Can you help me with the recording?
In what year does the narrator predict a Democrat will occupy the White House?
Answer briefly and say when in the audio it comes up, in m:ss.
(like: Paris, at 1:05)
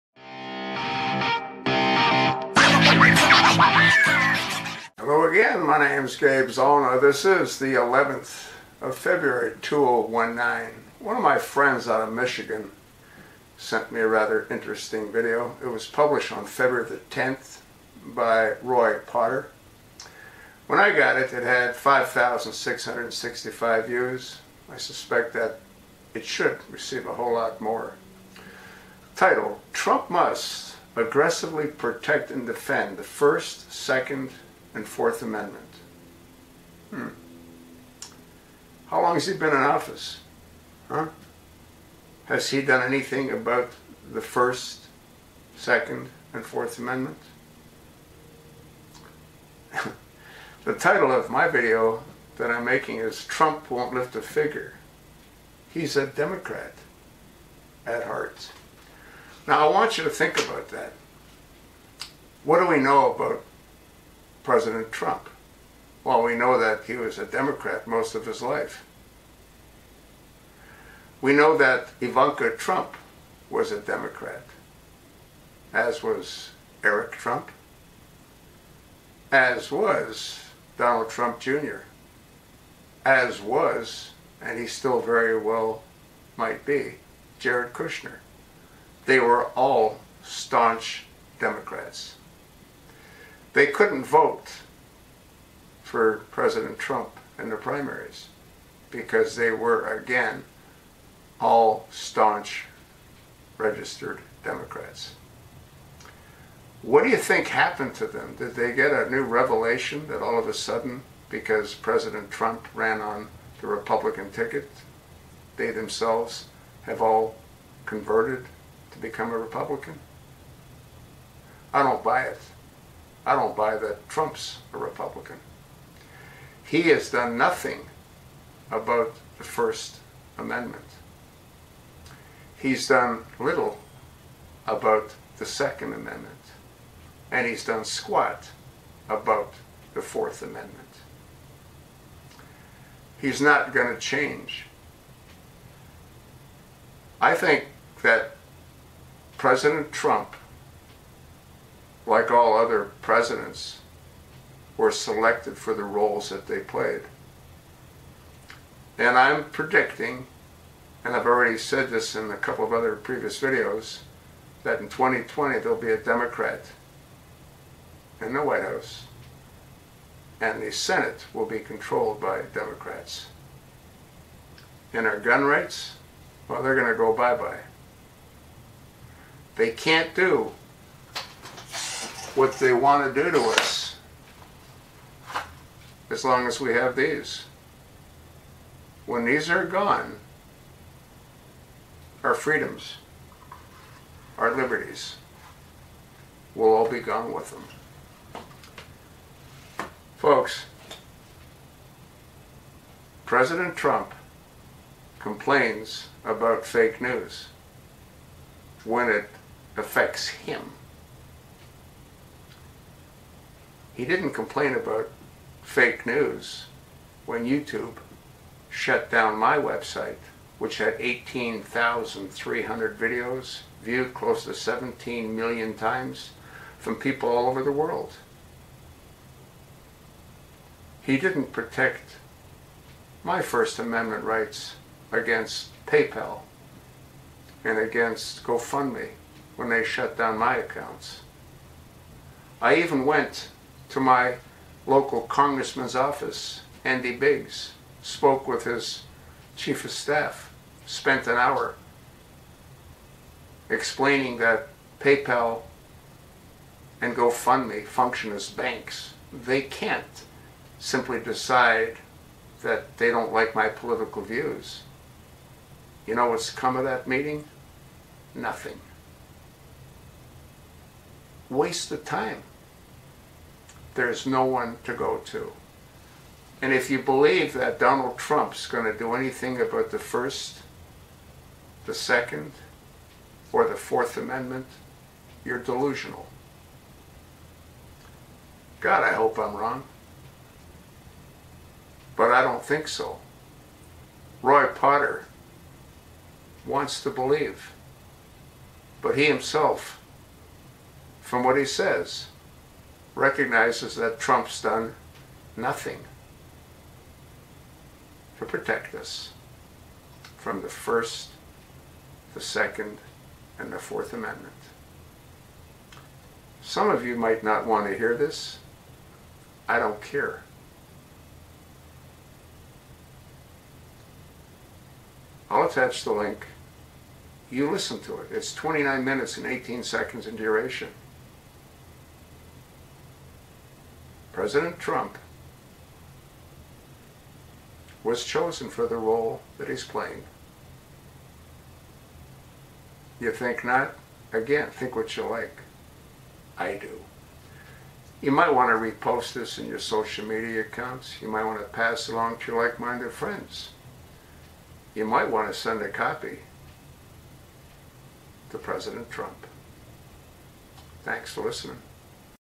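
2020, at 2:44.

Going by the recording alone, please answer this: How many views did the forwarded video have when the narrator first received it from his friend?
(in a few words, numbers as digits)
5,665.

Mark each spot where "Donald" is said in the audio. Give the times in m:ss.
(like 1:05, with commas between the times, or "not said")
1:20, 4:37.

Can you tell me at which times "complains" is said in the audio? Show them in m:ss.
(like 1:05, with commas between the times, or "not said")
3:25, 3:34.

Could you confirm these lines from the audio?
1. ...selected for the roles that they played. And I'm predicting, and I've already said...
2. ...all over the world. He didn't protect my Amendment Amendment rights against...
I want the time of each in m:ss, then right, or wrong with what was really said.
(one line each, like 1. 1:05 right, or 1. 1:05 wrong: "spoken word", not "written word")
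1. 2:34 right
2. 3:47 wrong: "First", not "Amendment".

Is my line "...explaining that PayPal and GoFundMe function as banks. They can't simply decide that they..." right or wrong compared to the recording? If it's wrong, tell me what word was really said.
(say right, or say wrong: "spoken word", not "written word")
right.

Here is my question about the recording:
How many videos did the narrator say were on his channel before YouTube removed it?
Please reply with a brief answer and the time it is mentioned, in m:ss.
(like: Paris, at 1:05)
18,300, at 3:40.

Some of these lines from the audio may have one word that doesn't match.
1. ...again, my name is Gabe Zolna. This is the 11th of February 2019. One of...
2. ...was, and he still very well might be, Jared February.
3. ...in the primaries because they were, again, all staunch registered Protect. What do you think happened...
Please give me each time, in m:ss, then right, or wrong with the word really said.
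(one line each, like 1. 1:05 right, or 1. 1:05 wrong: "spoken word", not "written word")
1. 0:05 right
2. 1:23 wrong: "Kushner", not "February"
3. 1:37 wrong: "Democrats", not "Protect".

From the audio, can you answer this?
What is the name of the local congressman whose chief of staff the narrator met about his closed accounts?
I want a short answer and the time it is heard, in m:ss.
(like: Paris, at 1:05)
Andy Biggs, at 4:06.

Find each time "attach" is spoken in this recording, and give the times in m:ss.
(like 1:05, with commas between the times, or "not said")
5:25.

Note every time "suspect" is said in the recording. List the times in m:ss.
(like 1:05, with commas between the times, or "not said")
0:24.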